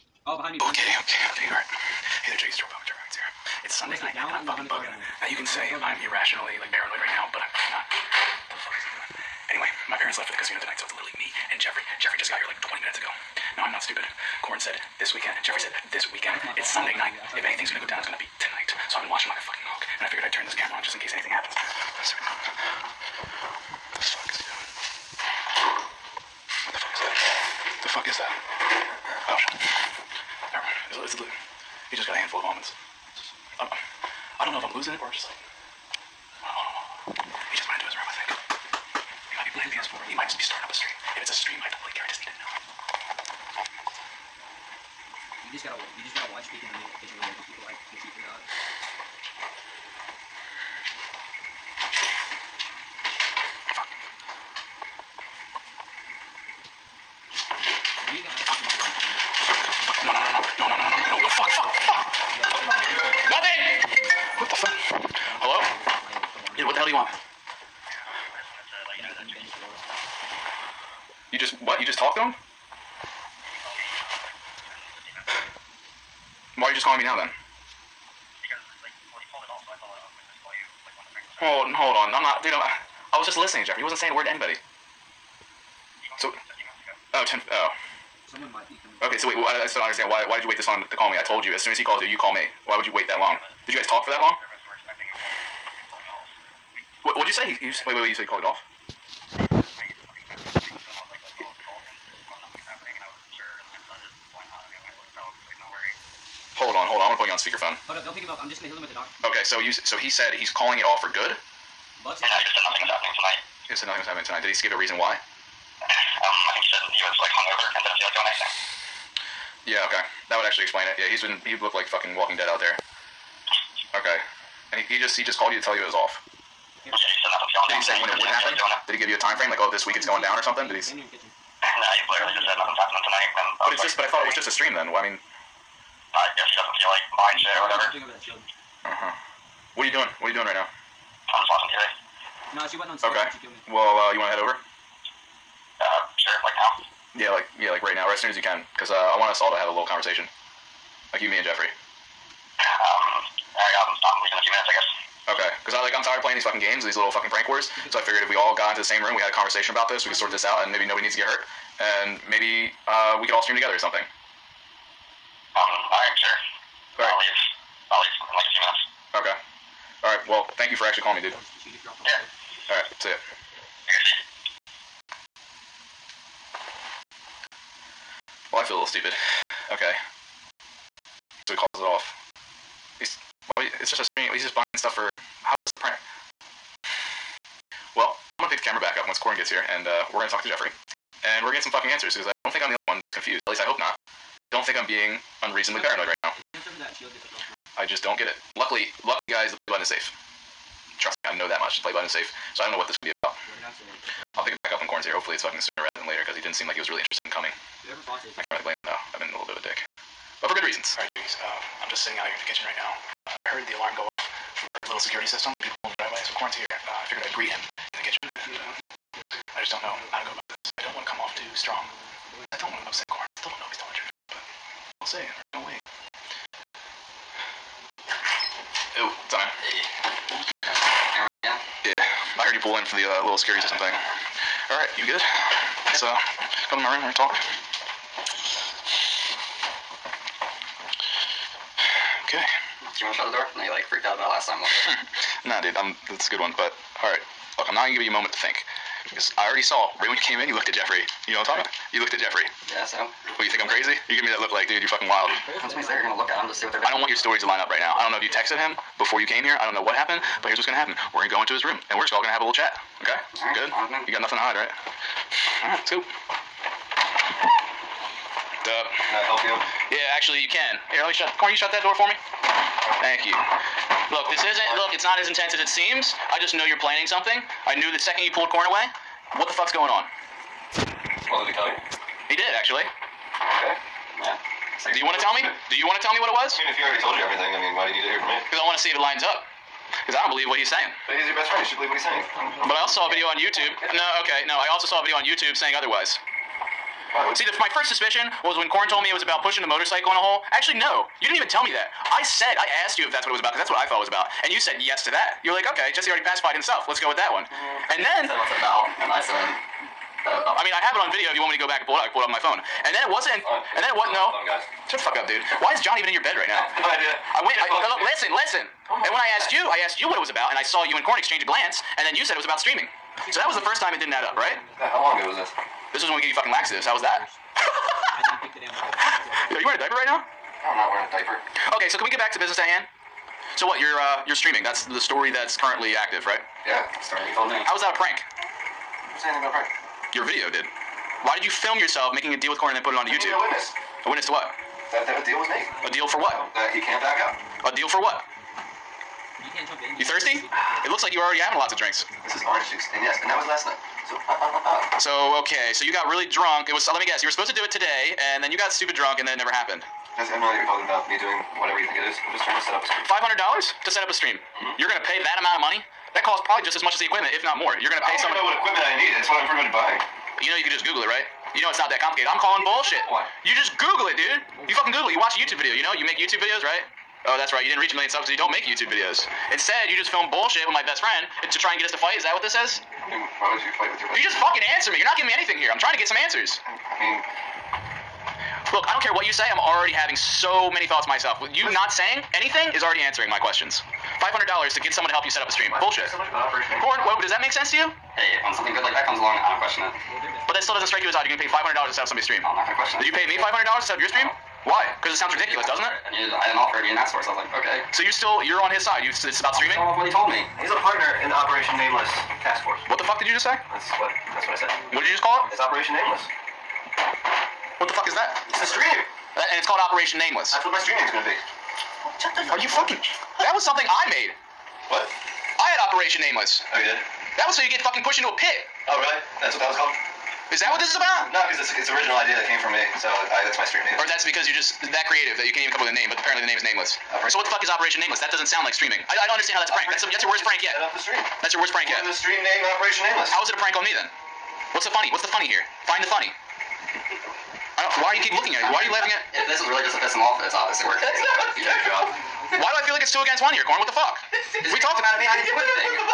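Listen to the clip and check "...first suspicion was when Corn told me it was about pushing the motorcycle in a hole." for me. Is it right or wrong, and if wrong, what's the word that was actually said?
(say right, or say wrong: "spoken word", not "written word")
right.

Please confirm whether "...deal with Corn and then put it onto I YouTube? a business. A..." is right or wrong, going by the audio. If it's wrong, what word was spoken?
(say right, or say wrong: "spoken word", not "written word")
wrong: "witness", not "business".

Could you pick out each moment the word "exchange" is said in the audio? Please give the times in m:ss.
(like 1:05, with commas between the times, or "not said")
5:21.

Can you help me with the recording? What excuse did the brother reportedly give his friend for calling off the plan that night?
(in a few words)
hungover.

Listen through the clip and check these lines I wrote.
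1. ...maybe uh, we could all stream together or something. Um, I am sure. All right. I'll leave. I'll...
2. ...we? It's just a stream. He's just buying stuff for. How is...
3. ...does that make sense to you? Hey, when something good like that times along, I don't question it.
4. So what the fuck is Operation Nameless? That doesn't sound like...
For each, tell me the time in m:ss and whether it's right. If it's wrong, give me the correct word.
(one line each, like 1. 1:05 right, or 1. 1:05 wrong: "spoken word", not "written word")
1. 2:42 right
2. 3:03 right
3. 6:37 wrong: "comes", not "times"
4. 7:17 right.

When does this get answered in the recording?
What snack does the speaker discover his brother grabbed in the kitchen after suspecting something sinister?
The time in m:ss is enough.
0:32.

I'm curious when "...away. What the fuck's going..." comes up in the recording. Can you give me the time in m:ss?
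4:38.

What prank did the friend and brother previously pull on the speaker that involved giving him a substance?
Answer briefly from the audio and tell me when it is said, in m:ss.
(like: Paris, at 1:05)
laxatives, at 5:26.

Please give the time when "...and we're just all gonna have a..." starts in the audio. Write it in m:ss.
4:21.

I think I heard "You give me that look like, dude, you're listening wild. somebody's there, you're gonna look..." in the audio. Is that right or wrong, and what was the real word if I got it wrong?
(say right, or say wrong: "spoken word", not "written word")
wrong: "fucking", not "listening".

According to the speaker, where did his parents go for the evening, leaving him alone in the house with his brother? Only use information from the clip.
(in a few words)
the casino.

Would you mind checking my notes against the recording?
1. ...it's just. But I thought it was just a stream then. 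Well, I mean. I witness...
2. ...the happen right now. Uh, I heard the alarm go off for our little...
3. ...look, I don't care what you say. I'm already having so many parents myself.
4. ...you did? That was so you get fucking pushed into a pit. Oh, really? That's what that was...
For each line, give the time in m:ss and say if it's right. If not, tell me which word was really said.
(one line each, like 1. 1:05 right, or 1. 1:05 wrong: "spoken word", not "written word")
1. 2:13 wrong: "guess", not "witness"
2. 3:32 wrong: "kitchen", not "happen"
3. 6:28 wrong: "thoughts", not "parents"
4. 7:06 right.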